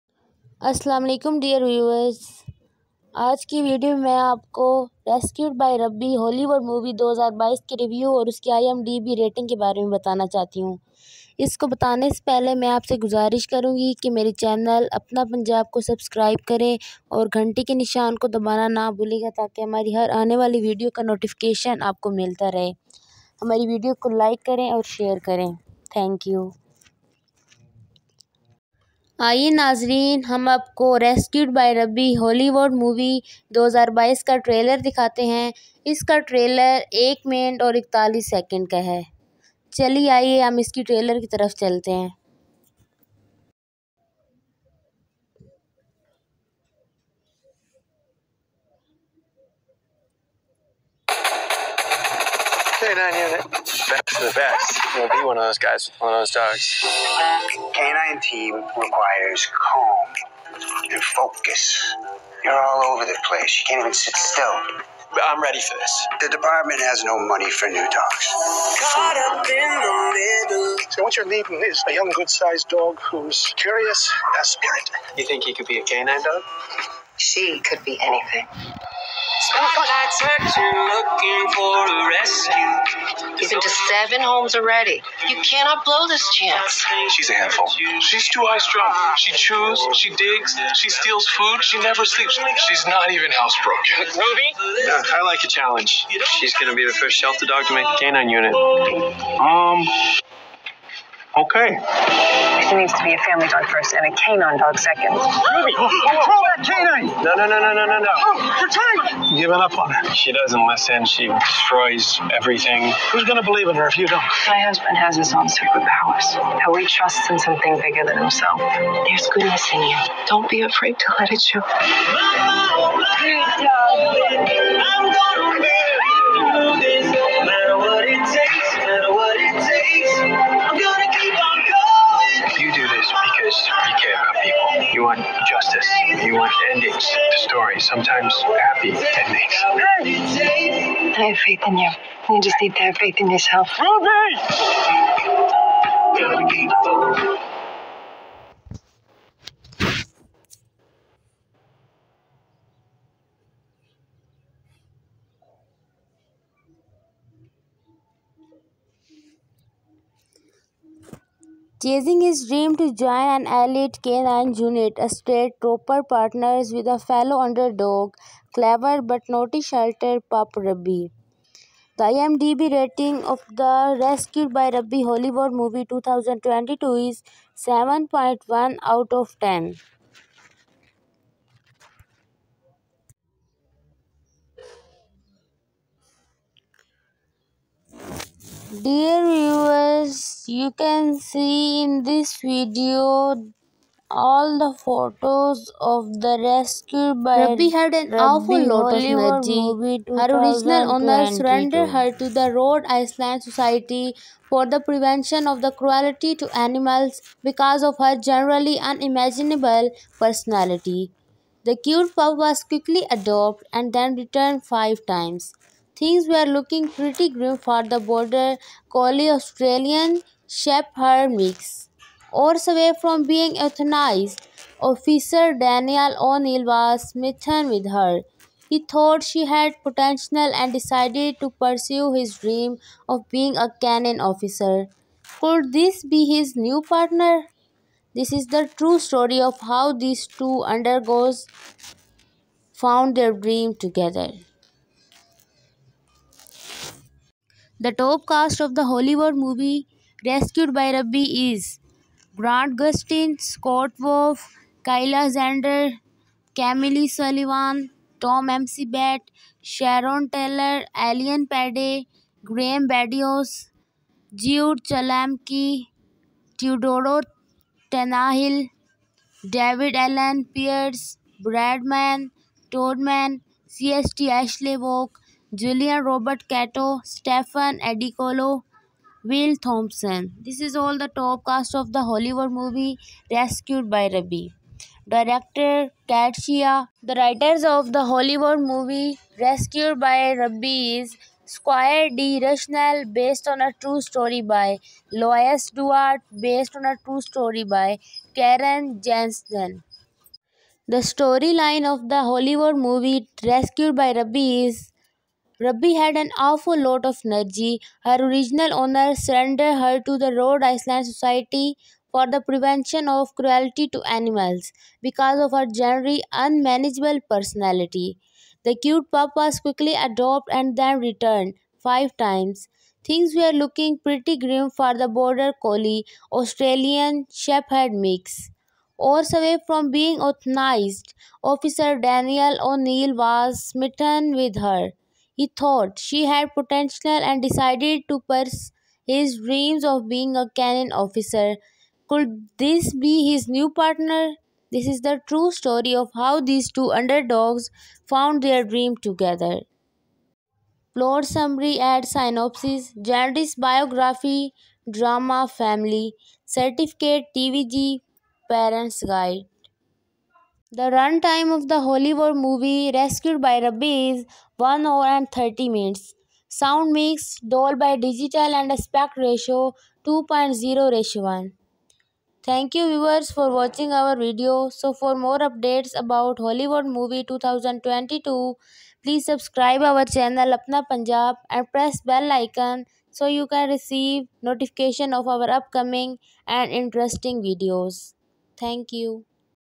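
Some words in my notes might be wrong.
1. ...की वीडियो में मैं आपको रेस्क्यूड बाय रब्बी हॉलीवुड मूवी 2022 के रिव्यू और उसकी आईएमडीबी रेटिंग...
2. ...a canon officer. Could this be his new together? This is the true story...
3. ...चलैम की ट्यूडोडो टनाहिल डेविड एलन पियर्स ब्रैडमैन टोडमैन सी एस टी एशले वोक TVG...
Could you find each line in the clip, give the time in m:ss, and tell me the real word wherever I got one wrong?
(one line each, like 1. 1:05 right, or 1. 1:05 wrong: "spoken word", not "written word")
1. 0:03 right
2. 3:53 wrong: "partner", not "together"
3. 4:24 wrong: "Julian", not "TVG".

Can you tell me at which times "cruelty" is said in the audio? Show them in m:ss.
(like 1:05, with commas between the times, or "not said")
3:25, 5:13.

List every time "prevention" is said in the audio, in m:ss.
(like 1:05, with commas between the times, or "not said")
3:24, 5:12.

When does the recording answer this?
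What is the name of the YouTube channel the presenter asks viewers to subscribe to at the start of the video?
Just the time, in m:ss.
0:15.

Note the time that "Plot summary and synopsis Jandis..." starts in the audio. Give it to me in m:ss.
5:50.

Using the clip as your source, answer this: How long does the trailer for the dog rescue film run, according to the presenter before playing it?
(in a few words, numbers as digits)
1 minute 41 seconds.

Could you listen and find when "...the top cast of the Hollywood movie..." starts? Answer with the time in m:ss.
4:40.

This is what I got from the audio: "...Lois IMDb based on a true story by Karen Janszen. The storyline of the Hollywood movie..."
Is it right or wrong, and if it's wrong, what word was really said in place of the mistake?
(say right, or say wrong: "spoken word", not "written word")
wrong: "Duarte", not "IMDb".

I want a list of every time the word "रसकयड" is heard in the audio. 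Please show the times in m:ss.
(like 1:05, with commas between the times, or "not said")
0:05, 0:31, 4:10.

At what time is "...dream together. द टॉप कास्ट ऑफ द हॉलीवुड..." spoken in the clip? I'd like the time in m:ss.
4:03.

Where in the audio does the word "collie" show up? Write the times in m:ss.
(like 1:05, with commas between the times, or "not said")
3:38, 5:25.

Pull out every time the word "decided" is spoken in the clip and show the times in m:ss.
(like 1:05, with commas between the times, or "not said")
3:50, 5:37.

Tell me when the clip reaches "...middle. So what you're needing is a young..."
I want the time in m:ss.
1:10.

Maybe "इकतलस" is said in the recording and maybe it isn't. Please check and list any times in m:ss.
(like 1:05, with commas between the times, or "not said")
0:37.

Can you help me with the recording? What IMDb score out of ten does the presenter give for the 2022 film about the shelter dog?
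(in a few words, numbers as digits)
7.1.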